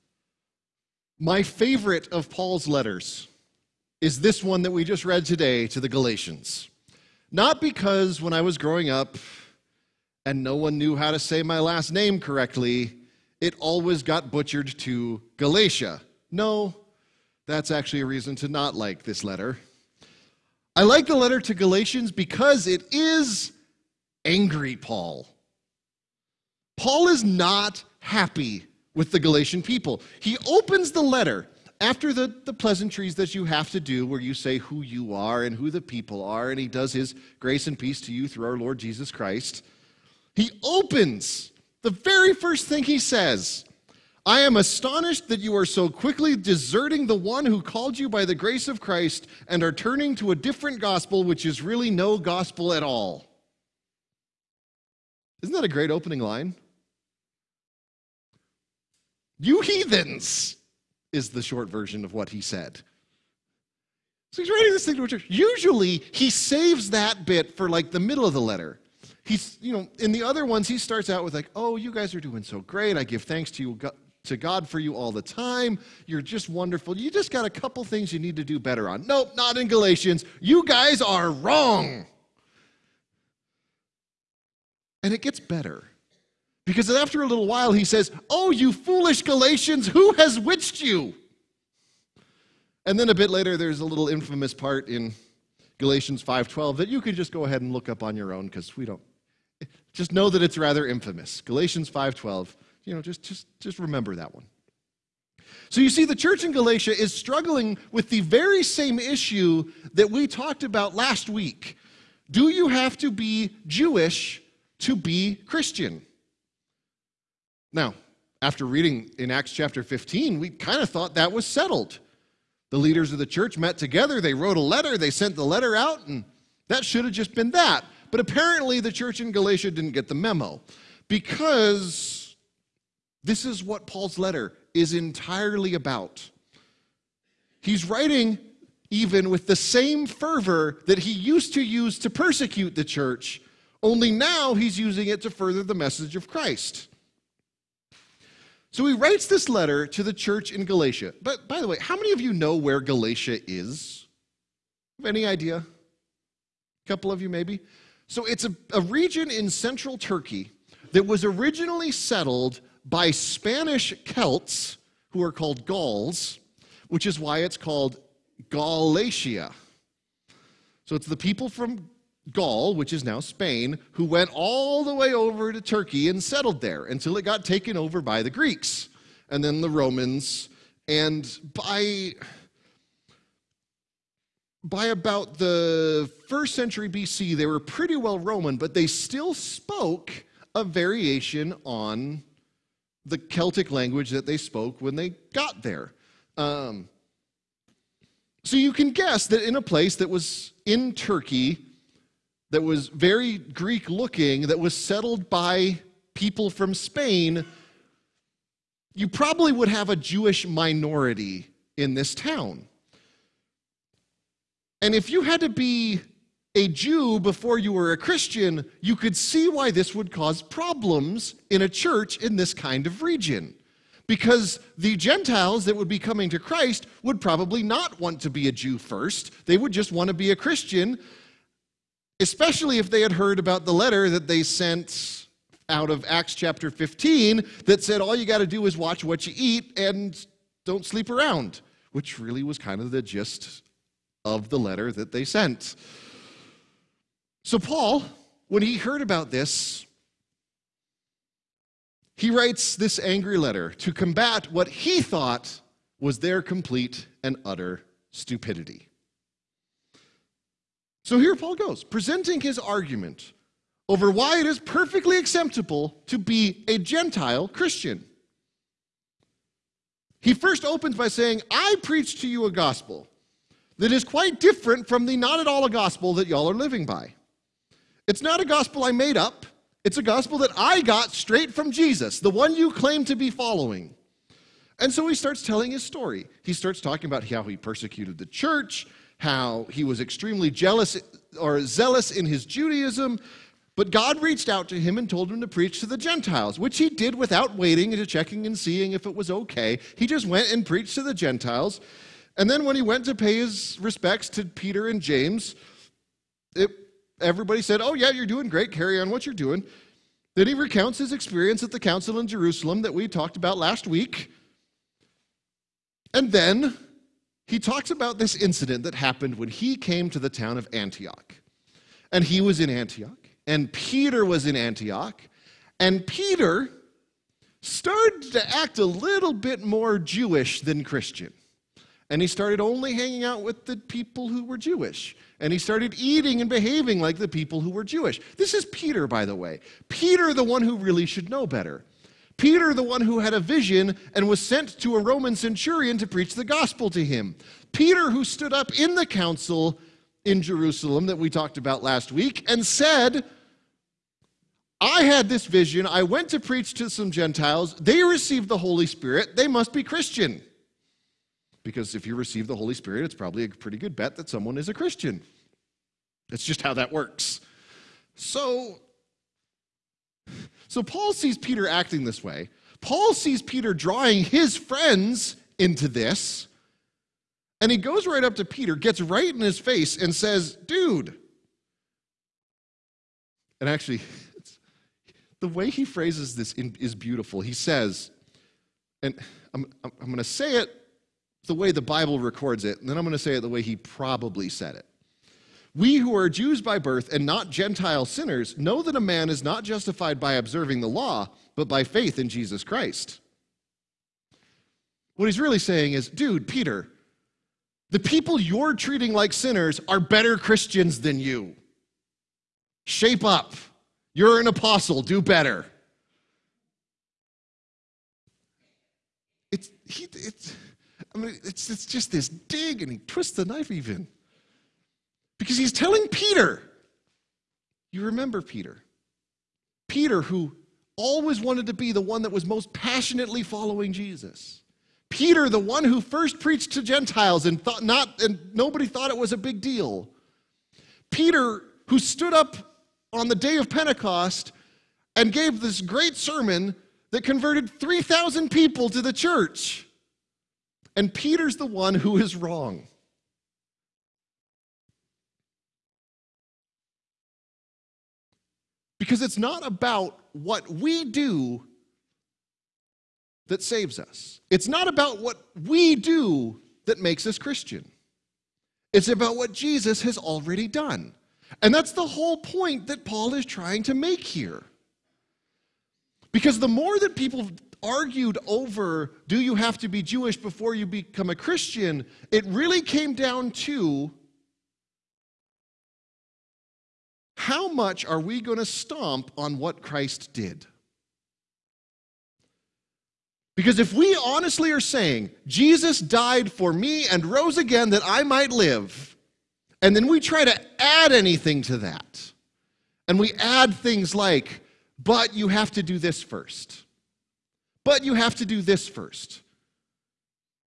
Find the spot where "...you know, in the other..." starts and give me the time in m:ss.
1:09.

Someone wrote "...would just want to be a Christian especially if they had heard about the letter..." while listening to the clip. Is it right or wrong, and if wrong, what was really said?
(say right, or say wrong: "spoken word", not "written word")
right.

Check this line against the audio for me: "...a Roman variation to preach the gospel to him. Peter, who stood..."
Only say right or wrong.
wrong.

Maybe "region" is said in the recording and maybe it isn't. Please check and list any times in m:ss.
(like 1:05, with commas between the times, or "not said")
2:38, 3:43.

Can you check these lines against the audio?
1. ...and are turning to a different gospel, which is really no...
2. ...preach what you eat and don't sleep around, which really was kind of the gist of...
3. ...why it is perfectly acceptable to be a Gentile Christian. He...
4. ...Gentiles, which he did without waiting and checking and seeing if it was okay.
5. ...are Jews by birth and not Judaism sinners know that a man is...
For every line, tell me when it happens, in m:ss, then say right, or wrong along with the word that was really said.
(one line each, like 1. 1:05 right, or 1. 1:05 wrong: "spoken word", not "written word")
1. 0:49 right
2. 3:58 wrong: "watch", not "preach"
3. 4:24 right
4. 4:55 right
5. 6:36 wrong: "Gentile", not "Judaism".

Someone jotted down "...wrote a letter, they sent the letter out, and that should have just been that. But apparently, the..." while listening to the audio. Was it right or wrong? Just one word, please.
right.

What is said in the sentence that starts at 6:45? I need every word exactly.
What he's really saying is, dude, Peter, the people you're treating like sinners are better Christians than you.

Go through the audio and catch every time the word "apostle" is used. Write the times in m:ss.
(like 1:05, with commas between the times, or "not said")
6:54.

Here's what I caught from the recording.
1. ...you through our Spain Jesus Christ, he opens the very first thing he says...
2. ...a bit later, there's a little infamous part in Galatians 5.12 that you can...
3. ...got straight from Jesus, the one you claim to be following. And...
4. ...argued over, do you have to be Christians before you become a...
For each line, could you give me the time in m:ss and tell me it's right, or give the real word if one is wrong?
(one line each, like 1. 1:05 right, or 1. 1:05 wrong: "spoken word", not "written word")
1. 0:38 wrong: "Lord", not "Spain"
2. 1:33 right
3. 4:40 right
4. 7:57 wrong: "Jewish", not "Christians".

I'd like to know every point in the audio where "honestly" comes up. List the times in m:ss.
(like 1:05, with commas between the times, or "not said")
8:14.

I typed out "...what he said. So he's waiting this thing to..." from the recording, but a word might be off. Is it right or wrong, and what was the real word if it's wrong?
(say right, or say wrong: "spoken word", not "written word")
wrong: "writing", not "waiting".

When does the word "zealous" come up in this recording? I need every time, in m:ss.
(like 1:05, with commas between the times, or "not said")
4:51.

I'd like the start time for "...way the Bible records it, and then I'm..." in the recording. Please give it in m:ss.
6:31.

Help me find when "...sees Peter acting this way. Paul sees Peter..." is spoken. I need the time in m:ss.
6:11.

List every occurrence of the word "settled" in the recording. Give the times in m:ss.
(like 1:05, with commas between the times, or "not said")
2:01, 2:41, 2:56, 3:24.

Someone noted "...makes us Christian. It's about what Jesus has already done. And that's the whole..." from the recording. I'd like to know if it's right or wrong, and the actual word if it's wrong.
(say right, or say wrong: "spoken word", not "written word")
right.